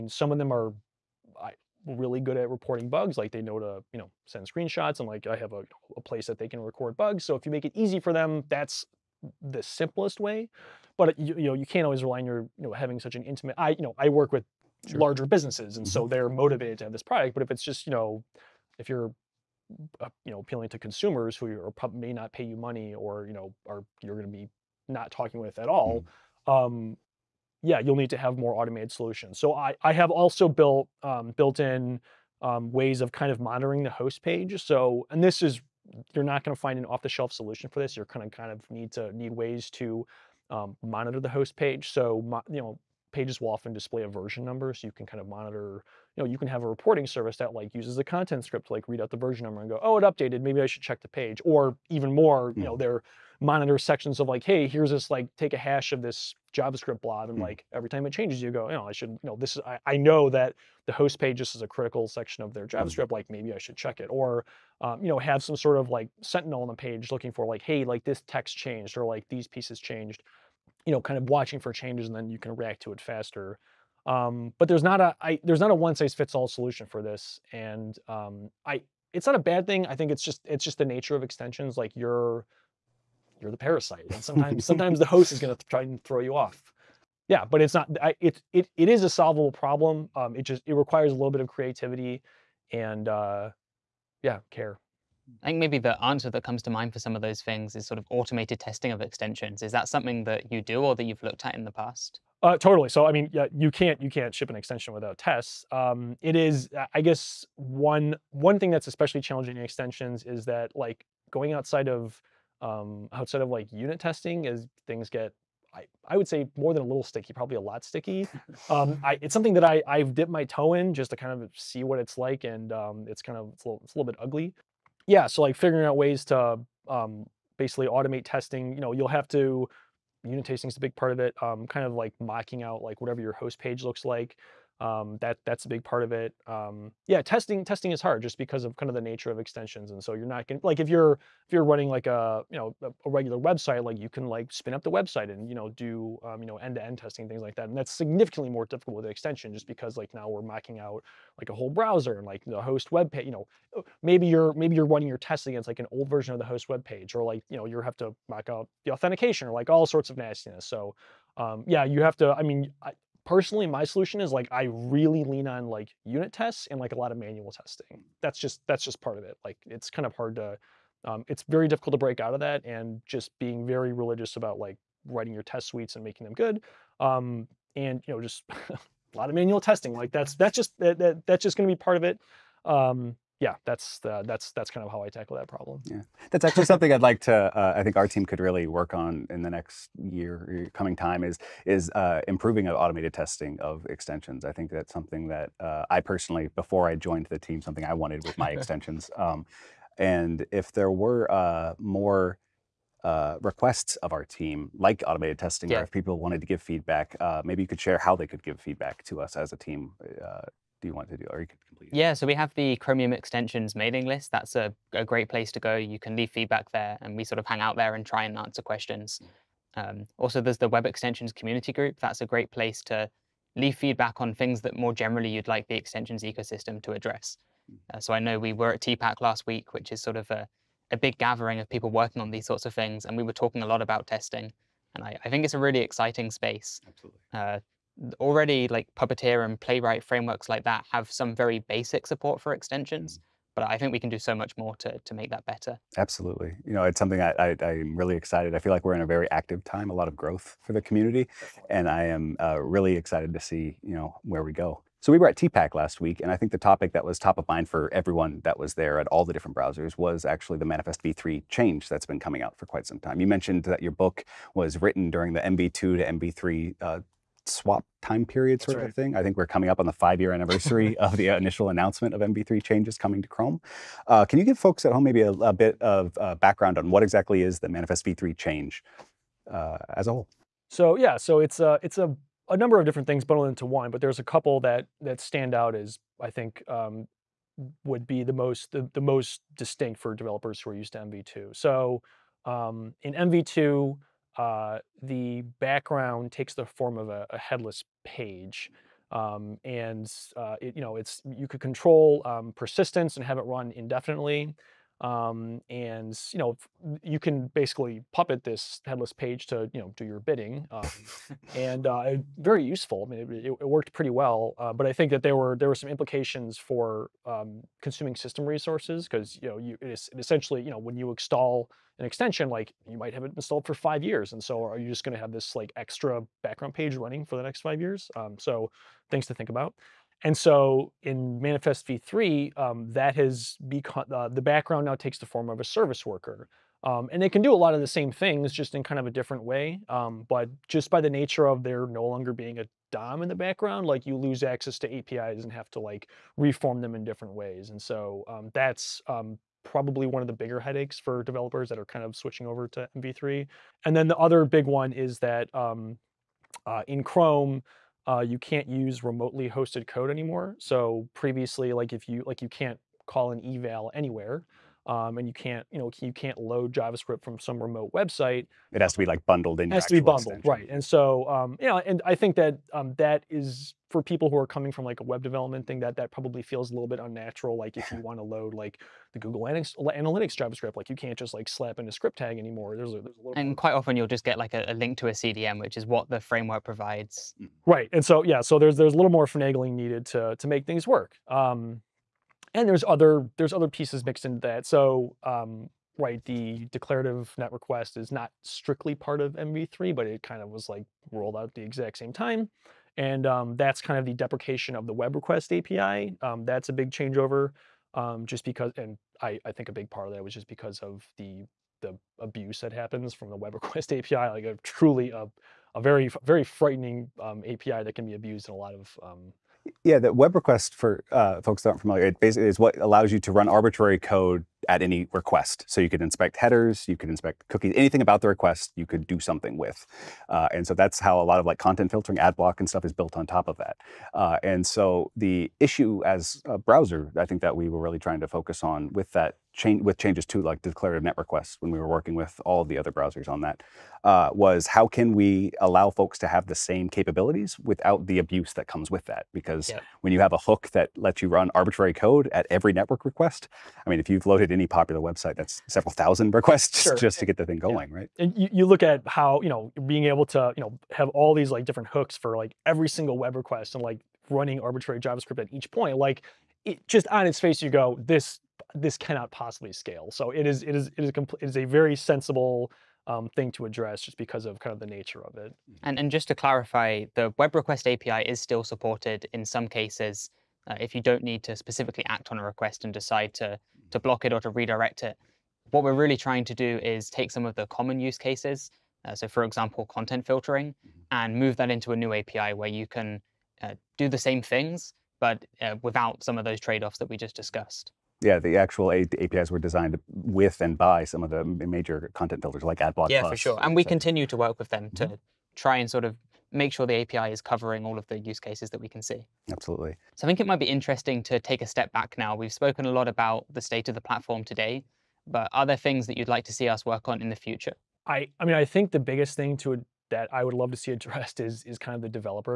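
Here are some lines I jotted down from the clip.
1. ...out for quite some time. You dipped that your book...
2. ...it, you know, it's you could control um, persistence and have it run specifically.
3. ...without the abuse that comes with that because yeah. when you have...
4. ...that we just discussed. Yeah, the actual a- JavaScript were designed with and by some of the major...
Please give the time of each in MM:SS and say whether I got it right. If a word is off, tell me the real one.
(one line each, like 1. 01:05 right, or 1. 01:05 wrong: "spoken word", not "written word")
1. 04:22 wrong: "mentioned", not "dipped"
2. 05:00 wrong: "indefinitely", not "specifically"
3. 07:27 right
4. 08:16 wrong: "APIs", not "JavaScript".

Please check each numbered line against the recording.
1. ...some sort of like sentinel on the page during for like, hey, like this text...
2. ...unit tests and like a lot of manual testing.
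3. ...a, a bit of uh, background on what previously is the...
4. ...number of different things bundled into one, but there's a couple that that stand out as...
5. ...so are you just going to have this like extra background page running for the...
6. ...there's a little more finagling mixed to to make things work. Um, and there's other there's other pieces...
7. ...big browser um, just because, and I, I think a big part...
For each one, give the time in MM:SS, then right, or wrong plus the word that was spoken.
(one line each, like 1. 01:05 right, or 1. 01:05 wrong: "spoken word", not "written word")
1. 01:05 wrong: "looking", not "during"
2. 02:46 right
3. 04:35 wrong: "exactly", not "previously"
4. 04:42 right
5. 05:24 right
6. 06:28 wrong: "needed", not "mixed"
7. 06:46 wrong: "changeover", not "browser".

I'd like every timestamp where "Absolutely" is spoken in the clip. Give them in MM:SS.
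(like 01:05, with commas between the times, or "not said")
03:56, 04:05, 08:29.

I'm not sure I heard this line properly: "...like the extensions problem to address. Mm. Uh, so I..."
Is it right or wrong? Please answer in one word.
wrong.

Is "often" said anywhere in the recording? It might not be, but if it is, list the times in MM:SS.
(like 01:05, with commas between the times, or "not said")
00:43, 06:23.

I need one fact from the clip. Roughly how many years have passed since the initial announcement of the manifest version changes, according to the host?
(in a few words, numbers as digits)
5.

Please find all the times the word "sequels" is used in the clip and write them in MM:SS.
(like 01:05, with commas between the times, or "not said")
not said.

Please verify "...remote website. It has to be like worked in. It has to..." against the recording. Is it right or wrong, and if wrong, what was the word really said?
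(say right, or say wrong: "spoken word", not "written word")
wrong: "bundled", not "worked".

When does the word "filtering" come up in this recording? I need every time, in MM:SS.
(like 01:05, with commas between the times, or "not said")
07:11, 08:10.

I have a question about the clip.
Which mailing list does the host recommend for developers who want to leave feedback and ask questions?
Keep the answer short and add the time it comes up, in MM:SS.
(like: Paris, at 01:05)
Chromium extensions mailing list, at 03:32.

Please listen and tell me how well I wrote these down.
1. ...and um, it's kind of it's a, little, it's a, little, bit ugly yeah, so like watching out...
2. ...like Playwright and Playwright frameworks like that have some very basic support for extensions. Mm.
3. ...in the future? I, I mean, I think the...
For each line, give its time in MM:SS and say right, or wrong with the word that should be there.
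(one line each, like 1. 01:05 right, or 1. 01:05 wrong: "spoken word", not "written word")
1. 02:02 wrong: "figuring", not "watching"
2. 03:58 wrong: "Puppeteer", not "Playwright"
3. 08:37 right.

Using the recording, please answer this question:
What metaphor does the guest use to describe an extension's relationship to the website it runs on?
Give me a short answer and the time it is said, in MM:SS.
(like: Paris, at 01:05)
the parasite, at 01:23.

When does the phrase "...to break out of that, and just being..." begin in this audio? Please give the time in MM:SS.
02:51.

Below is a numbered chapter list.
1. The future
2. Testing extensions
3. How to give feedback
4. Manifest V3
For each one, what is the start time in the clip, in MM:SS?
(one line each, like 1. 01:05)
1. 08:19
2. 01:24
3. 02:54
4. 04:04.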